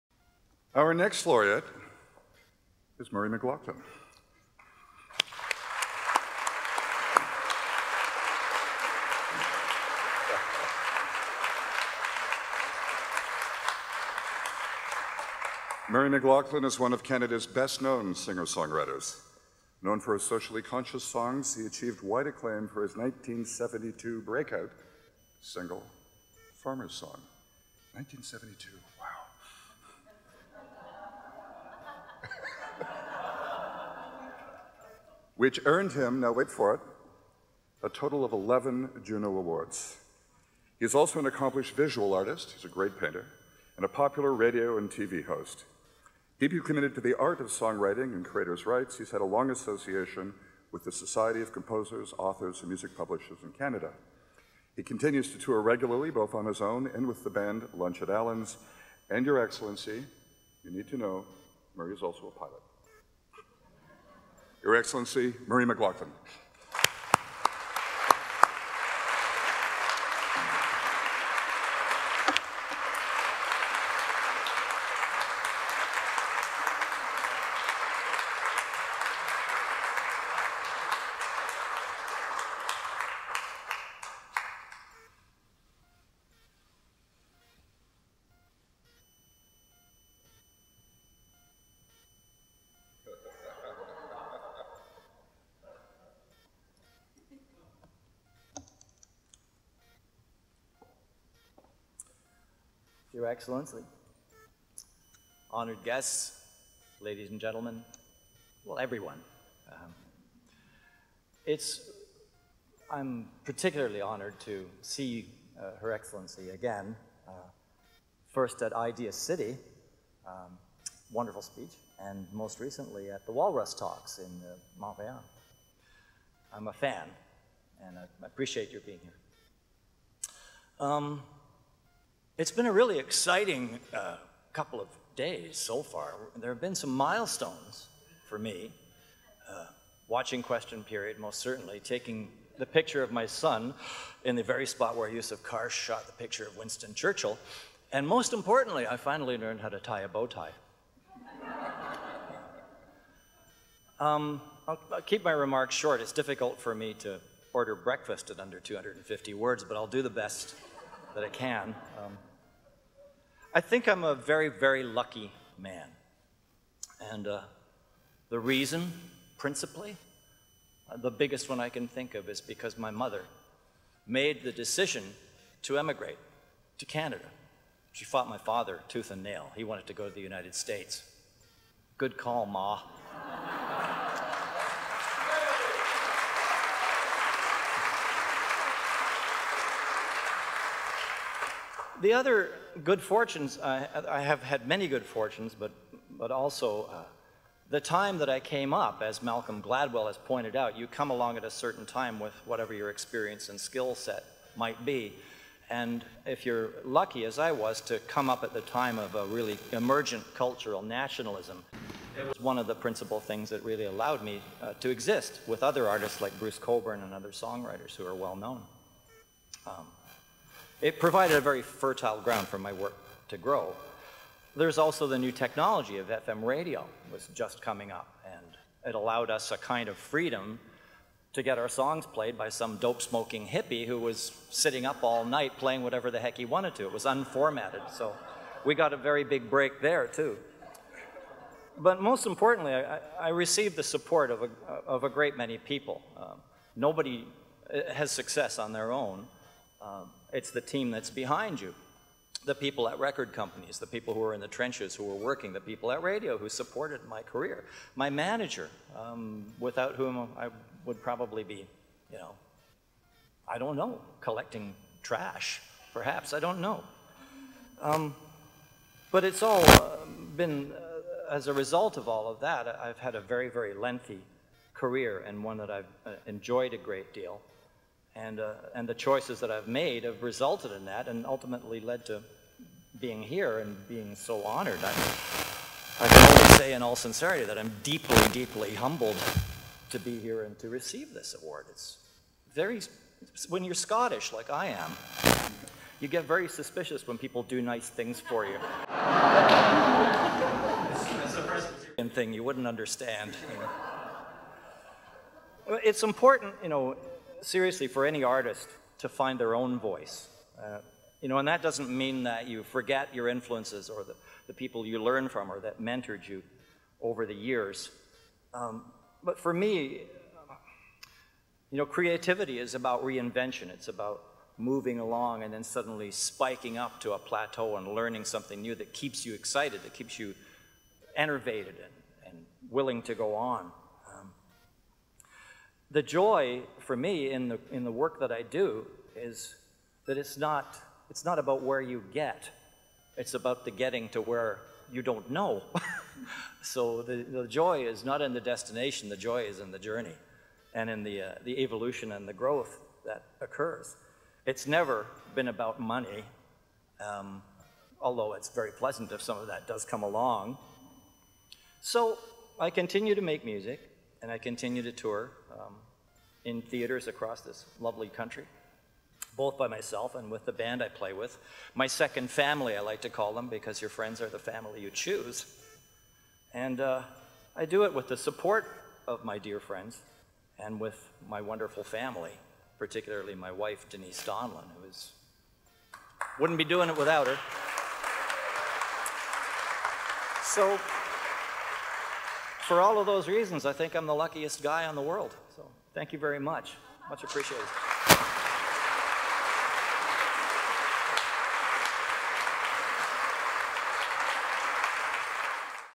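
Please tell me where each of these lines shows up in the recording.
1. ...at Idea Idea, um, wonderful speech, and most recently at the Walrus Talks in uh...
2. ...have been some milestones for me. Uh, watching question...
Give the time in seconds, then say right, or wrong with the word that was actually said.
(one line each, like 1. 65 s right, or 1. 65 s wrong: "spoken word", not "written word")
1. 118 s wrong: "City", not "Idea"
2. 136 s right.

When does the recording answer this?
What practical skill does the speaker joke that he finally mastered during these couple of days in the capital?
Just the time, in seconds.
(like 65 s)
149 s.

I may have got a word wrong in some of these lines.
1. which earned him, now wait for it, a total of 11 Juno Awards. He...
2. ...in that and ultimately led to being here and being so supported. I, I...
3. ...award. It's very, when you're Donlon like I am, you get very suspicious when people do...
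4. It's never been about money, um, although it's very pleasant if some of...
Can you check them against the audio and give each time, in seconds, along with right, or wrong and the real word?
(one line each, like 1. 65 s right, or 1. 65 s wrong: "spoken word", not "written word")
1. 35 s right
2. 280 s wrong: "honored", not "supported"
3. 291 s wrong: "Scottish", not "Donlon"
4. 354 s right.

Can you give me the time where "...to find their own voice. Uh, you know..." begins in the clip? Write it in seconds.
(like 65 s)
308 s.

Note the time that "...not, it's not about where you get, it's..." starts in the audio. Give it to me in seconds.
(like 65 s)
340 s.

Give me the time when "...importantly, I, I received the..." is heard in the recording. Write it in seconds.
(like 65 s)
242 s.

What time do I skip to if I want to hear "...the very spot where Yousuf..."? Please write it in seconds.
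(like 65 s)
144 s.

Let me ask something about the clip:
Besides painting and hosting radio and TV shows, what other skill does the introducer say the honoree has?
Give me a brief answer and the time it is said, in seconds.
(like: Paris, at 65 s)
pilot, at 62 s.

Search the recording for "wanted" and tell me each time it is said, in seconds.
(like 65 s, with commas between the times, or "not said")
179 s, 236 s.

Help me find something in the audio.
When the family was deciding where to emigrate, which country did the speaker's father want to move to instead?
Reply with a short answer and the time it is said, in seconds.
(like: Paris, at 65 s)
United States, at 180 s.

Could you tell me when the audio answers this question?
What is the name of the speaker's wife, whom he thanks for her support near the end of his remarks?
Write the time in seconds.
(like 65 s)
383 s.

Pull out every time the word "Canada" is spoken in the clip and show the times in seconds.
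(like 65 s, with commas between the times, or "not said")
17 s, 53 s, 176 s.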